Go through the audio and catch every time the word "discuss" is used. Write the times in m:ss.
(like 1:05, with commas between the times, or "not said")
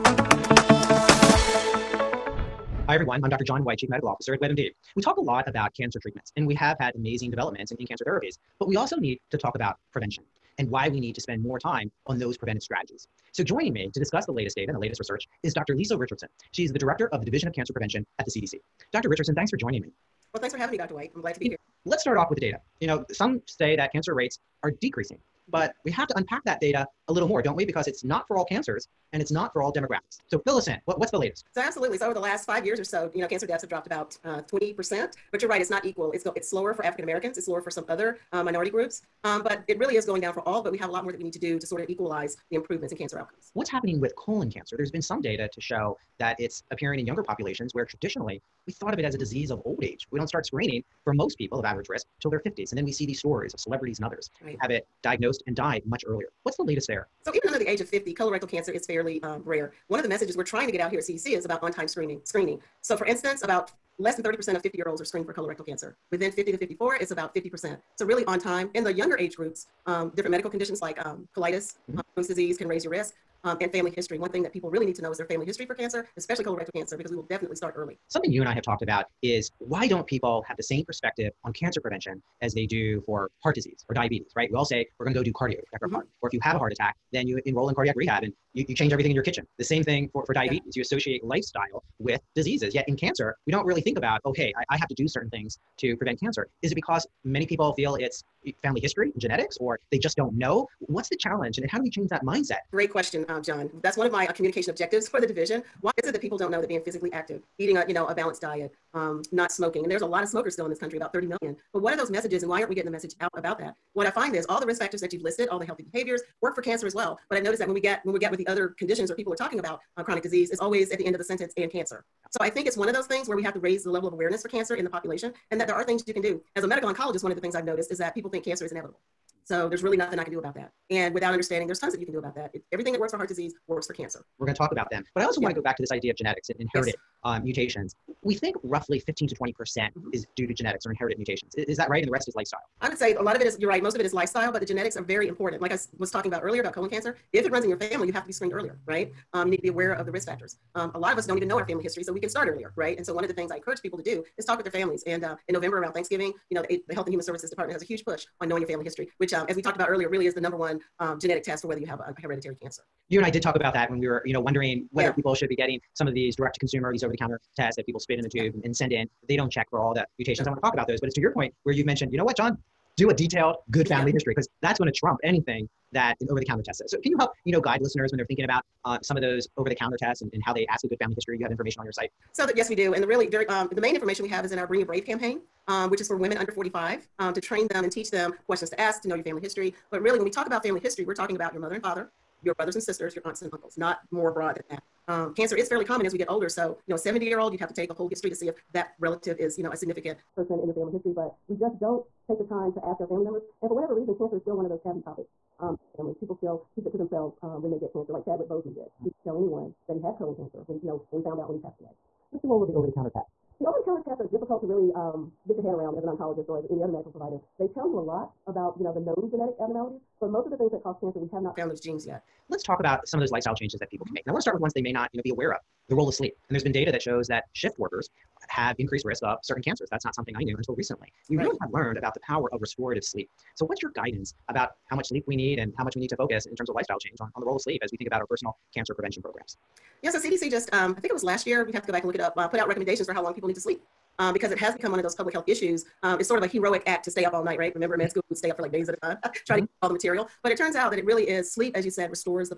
0:13.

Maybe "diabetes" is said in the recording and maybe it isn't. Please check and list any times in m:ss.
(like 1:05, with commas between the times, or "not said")
1:23, 1:30.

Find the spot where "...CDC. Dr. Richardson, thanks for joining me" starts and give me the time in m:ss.
0:18.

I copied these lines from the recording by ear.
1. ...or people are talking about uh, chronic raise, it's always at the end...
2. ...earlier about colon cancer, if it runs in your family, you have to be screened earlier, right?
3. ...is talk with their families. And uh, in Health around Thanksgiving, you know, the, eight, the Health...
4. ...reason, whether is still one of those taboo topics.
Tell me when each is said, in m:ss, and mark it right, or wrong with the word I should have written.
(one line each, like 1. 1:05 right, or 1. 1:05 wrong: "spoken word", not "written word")
1. 1:59 wrong: "disease", not "raise"
2. 2:26 right
3. 2:34 wrong: "November", not "Health"
4. 3:23 wrong: "cancer", not "whether".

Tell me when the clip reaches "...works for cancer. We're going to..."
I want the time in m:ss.
2:13.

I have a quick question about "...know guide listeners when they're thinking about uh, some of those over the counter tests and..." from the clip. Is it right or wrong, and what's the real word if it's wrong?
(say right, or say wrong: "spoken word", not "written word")
right.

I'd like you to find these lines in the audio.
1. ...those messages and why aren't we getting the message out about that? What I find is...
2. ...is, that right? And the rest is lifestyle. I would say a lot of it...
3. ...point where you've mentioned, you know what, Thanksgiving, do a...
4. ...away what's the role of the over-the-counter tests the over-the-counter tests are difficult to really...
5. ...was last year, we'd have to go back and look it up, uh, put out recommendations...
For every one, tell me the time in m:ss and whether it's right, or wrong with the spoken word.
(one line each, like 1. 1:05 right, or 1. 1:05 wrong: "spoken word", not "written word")
1. 1:51 right
2. 2:21 right
3. 2:51 wrong: "John", not "Thanksgiving"
4. 3:31 right
5. 4:01 right.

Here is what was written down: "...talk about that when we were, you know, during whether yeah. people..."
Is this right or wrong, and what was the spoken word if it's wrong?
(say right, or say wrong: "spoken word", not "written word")
wrong: "wondering", not "during".